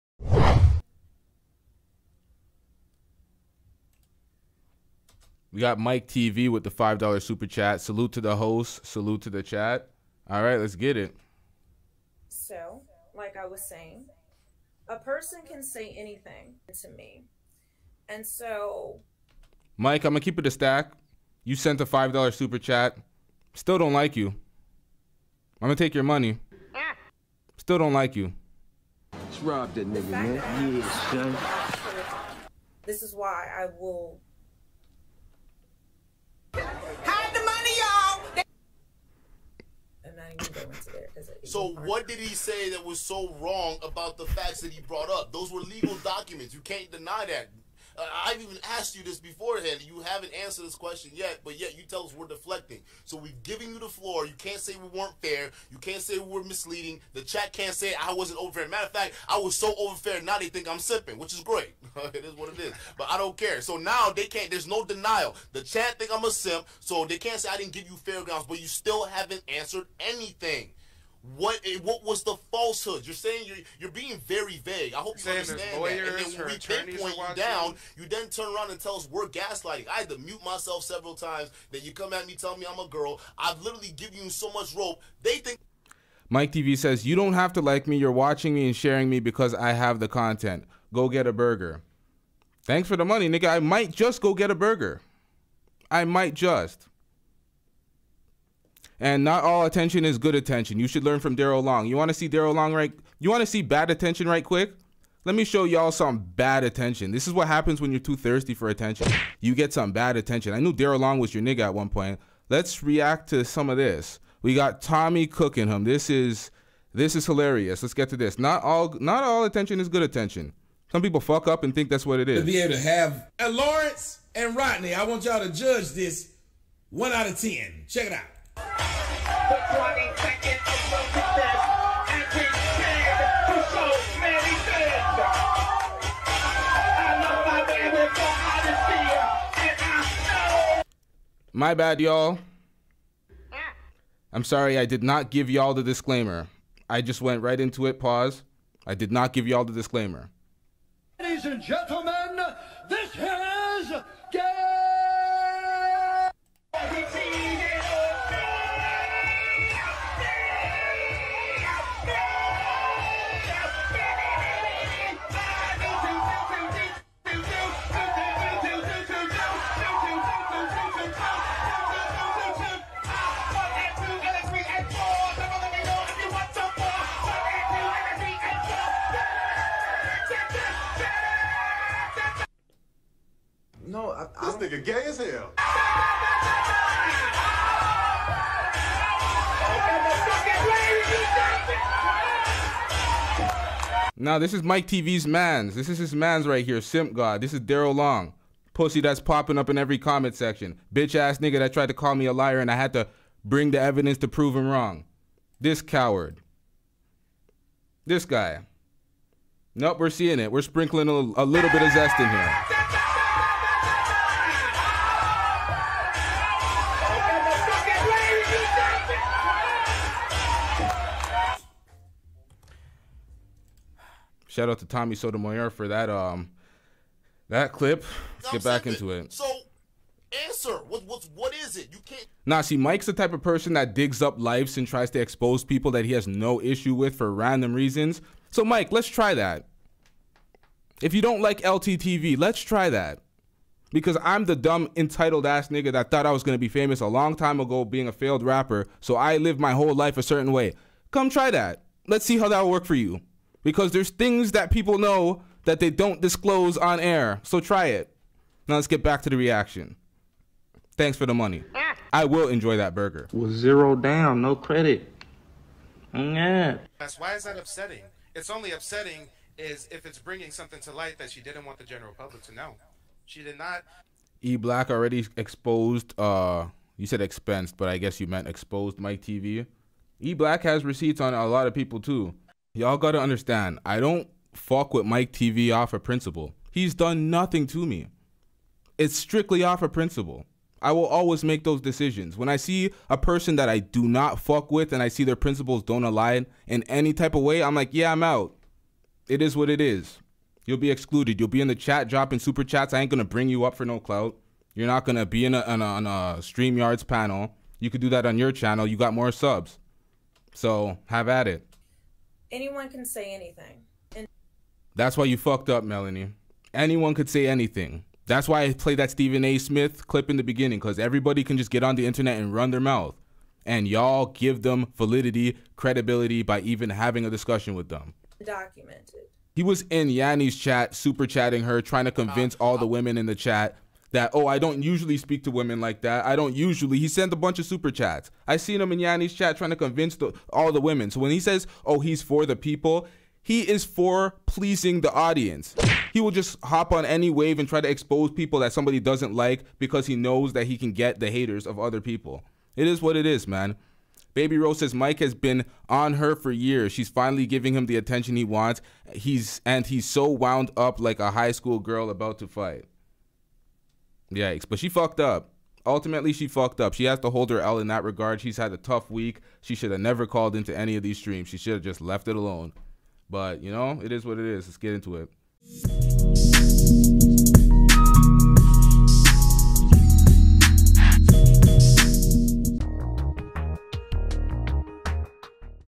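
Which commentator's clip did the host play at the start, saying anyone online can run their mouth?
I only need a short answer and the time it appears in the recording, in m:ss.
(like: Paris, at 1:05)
Stephen A. Smith, at 5:19.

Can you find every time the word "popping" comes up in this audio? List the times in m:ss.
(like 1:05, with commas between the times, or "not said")
3:19.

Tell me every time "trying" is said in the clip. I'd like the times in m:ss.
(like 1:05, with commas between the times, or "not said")
5:31, 5:39.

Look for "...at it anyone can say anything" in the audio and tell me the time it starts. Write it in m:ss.
5:11.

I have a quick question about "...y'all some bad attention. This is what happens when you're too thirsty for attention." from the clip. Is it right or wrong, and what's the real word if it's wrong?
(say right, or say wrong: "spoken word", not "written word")
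right.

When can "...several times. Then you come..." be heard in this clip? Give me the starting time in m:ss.
1:20.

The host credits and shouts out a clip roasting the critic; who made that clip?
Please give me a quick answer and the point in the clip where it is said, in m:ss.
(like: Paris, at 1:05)
Tommy Sotomayor, at 3:44.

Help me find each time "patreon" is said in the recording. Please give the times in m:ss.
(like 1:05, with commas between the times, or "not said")
not said.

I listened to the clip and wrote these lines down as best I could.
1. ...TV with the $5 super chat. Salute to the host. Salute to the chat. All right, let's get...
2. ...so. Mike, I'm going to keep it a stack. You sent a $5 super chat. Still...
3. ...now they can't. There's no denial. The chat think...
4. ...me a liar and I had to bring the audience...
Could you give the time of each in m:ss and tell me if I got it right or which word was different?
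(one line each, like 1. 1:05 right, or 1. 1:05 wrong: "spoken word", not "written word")
1. 0:06 right
2. 0:18 right
3. 1:03 right
4. 3:22 wrong: "evidence", not "audience".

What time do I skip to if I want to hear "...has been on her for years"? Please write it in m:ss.
5:55.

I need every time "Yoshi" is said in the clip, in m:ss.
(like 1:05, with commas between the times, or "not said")
not said.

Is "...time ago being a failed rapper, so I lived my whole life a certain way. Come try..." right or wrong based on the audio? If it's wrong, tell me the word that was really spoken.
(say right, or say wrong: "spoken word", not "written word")
right.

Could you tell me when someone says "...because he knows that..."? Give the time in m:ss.
5:49.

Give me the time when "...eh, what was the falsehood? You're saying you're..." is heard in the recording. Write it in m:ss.
1:11.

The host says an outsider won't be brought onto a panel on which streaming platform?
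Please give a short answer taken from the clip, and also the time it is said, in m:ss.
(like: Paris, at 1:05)
StreamYards, at 5:06.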